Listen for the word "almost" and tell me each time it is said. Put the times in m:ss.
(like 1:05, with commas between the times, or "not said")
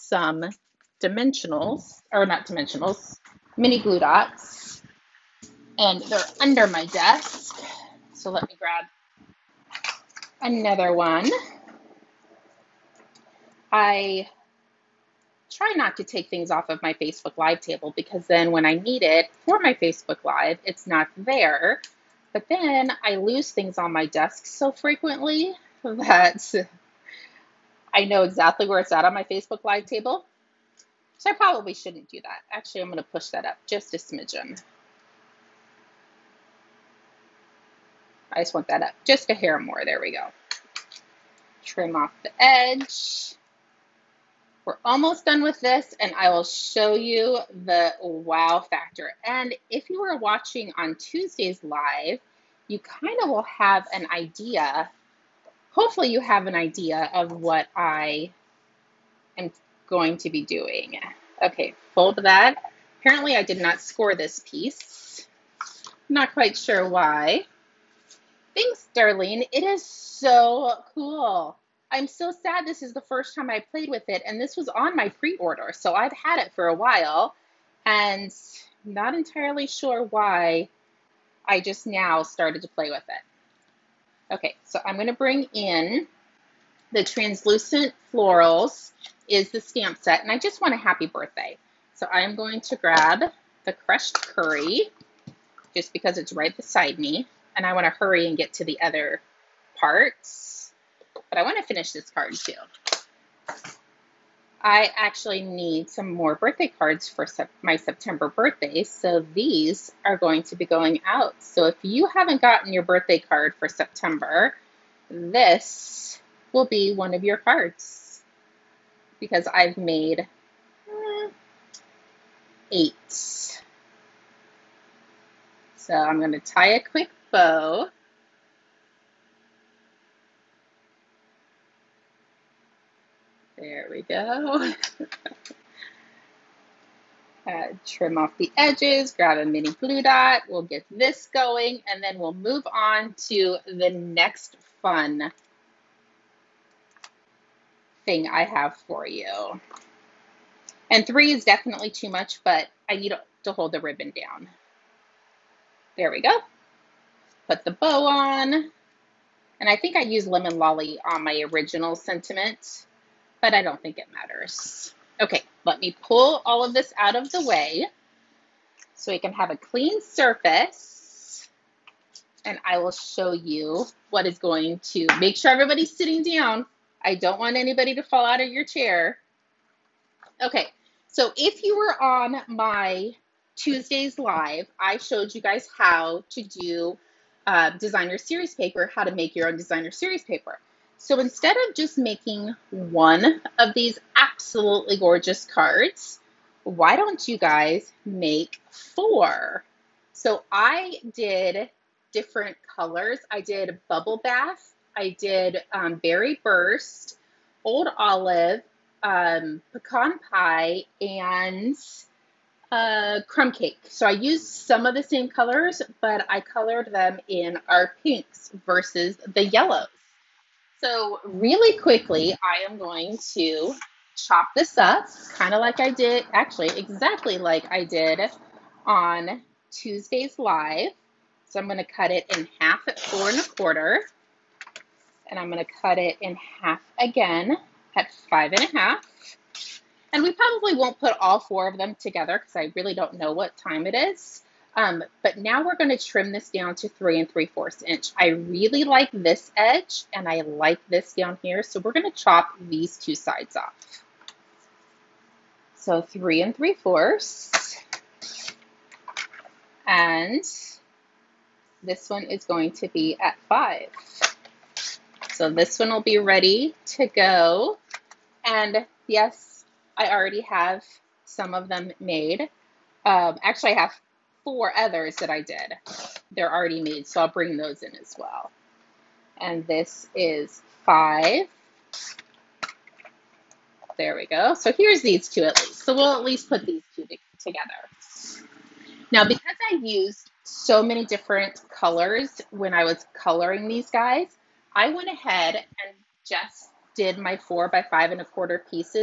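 0:44.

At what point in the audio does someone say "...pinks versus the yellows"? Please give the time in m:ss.
3:38.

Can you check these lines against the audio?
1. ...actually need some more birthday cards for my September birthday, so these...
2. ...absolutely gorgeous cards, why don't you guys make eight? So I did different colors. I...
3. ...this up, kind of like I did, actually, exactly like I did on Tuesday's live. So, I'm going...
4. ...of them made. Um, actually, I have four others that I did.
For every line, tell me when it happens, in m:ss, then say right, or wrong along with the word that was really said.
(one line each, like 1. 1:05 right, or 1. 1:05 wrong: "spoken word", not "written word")
1. 1:44 right
2. 3:14 wrong: "four", not "eight"
3. 3:44 right
4. 4:31 right.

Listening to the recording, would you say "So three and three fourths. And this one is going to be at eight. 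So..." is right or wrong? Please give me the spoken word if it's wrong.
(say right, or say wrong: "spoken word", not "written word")
wrong: "five", not "eight".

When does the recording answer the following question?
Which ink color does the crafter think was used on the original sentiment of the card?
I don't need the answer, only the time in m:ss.
2:40.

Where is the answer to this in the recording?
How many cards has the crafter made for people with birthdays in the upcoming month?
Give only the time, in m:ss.
2:02.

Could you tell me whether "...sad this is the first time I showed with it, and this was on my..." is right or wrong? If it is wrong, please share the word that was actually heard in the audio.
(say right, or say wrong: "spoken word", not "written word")
wrong: "played", not "showed".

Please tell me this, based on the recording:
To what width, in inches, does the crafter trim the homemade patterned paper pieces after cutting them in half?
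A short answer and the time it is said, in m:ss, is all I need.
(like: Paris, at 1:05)
3 3/4, at 4:06.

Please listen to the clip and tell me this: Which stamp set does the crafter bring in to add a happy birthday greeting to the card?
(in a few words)
Translucent Florals.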